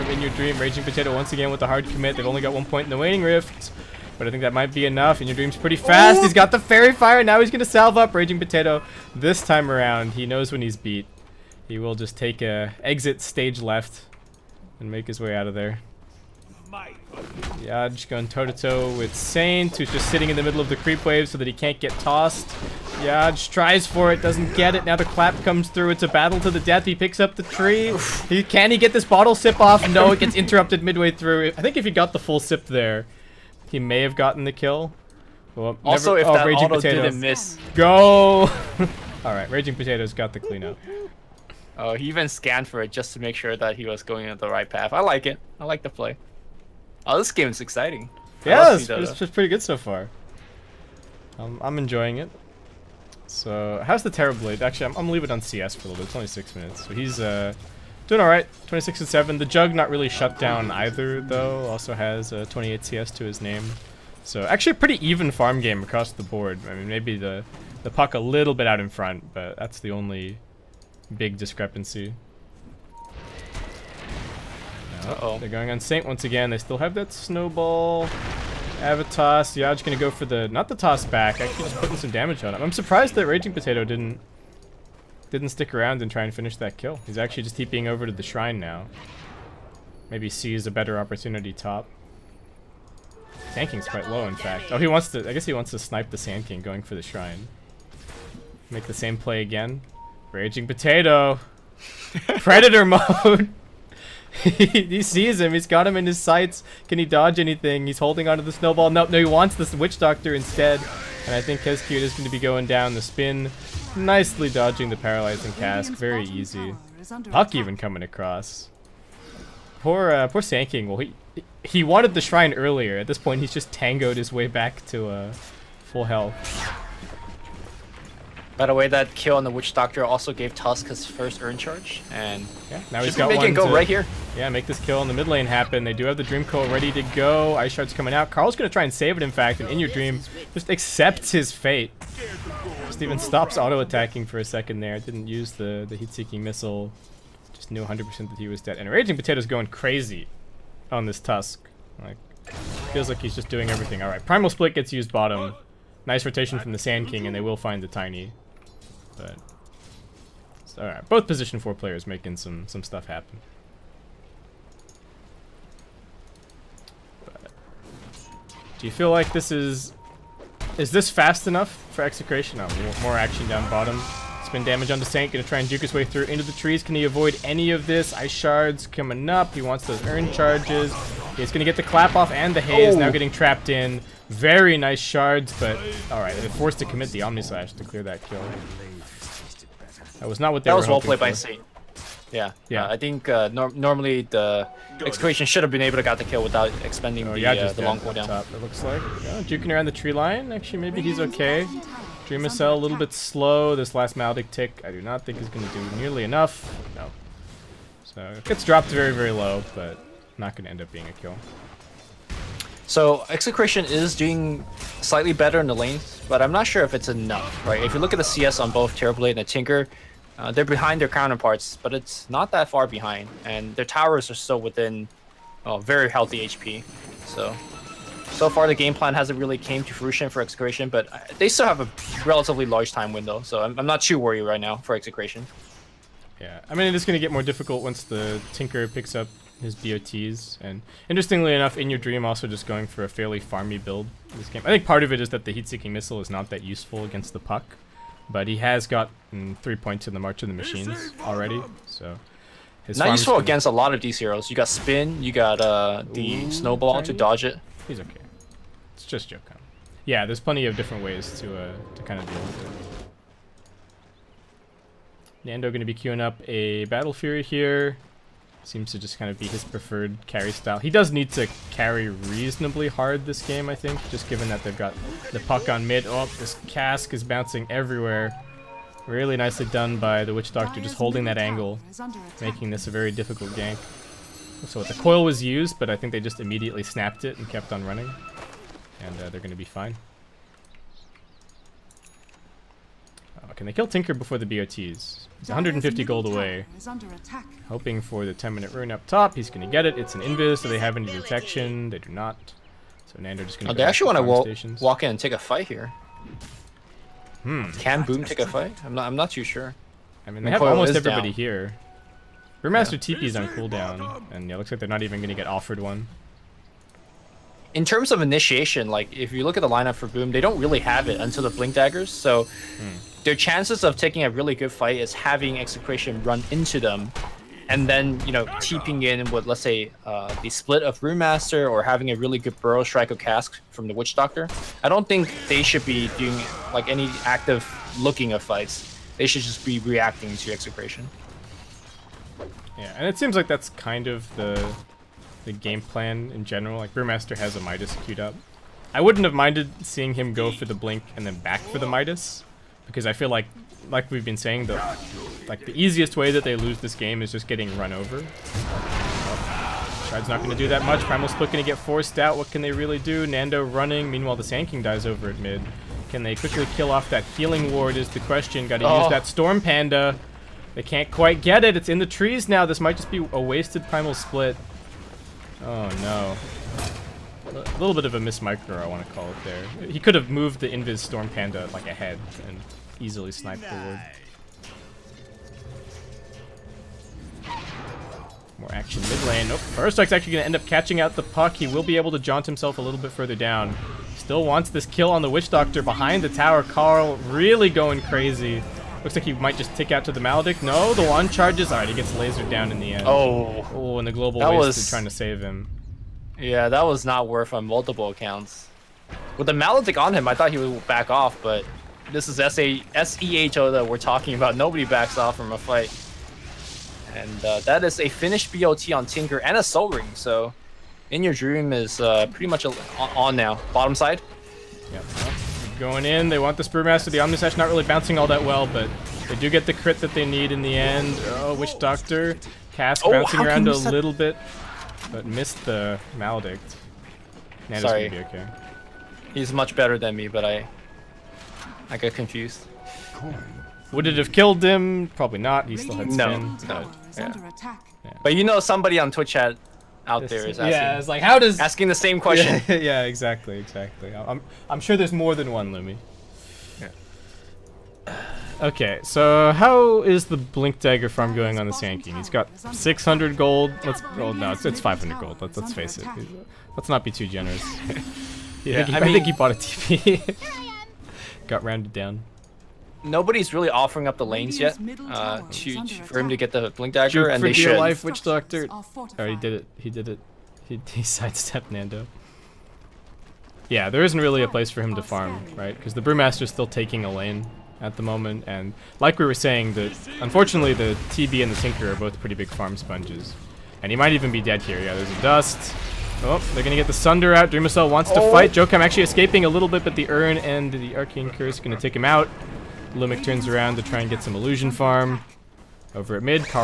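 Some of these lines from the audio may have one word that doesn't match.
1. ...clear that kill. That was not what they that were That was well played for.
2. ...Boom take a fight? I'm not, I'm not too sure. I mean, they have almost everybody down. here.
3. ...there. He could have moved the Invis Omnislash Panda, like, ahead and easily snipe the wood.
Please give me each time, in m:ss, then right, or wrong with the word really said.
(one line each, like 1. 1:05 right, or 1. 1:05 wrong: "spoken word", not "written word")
1. 3:07 right
2. 5:08 right
3. 6:19 wrong: "Storm", not "Omnislash".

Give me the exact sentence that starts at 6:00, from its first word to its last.
Shard's not going to do that much.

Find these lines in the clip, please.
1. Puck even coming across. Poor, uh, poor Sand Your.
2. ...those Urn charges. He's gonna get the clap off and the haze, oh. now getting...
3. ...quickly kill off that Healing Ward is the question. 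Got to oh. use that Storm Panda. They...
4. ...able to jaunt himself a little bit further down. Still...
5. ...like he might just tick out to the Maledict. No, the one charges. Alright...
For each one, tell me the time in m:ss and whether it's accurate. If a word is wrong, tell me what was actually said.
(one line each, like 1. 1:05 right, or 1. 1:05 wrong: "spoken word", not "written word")
1. 1:57 wrong: "King", not "Your"
2. 2:59 right
3. 6:06 right
4. 6:31 right
5. 6:39 right.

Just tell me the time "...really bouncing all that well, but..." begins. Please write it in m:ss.
7:07.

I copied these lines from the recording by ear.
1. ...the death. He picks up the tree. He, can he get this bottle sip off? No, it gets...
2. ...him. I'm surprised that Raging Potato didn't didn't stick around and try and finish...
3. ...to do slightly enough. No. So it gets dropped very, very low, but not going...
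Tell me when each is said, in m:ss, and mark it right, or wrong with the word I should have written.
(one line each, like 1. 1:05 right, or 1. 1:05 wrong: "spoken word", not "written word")
1. 0:26 right
2. 1:22 right
3. 3:25 wrong: "nearly", not "slightly".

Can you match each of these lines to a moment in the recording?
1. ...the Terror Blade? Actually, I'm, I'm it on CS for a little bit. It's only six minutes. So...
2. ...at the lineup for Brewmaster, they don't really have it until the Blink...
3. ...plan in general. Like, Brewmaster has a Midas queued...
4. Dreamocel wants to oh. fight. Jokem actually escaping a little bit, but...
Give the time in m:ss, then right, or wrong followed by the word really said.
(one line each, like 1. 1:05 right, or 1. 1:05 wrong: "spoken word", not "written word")
1. 0:54 right
2. 5:19 wrong: "Boom", not "Brewmaster"
3. 5:45 right
4. 8:17 right.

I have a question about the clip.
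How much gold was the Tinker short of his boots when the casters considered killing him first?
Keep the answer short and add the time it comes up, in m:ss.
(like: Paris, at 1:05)
150 gold, at 4:55.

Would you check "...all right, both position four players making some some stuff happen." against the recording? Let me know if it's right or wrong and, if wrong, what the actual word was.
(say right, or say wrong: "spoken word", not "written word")
right.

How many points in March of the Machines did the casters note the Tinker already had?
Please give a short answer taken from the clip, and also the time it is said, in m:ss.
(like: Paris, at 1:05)
3, at 4:09.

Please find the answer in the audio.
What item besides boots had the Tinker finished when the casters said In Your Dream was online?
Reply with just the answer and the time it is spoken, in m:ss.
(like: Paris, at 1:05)
Soul Ring, at 6:59.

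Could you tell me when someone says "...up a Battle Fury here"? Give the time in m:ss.
4:26.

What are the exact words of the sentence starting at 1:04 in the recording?
So actually, a pretty even farm game across the board.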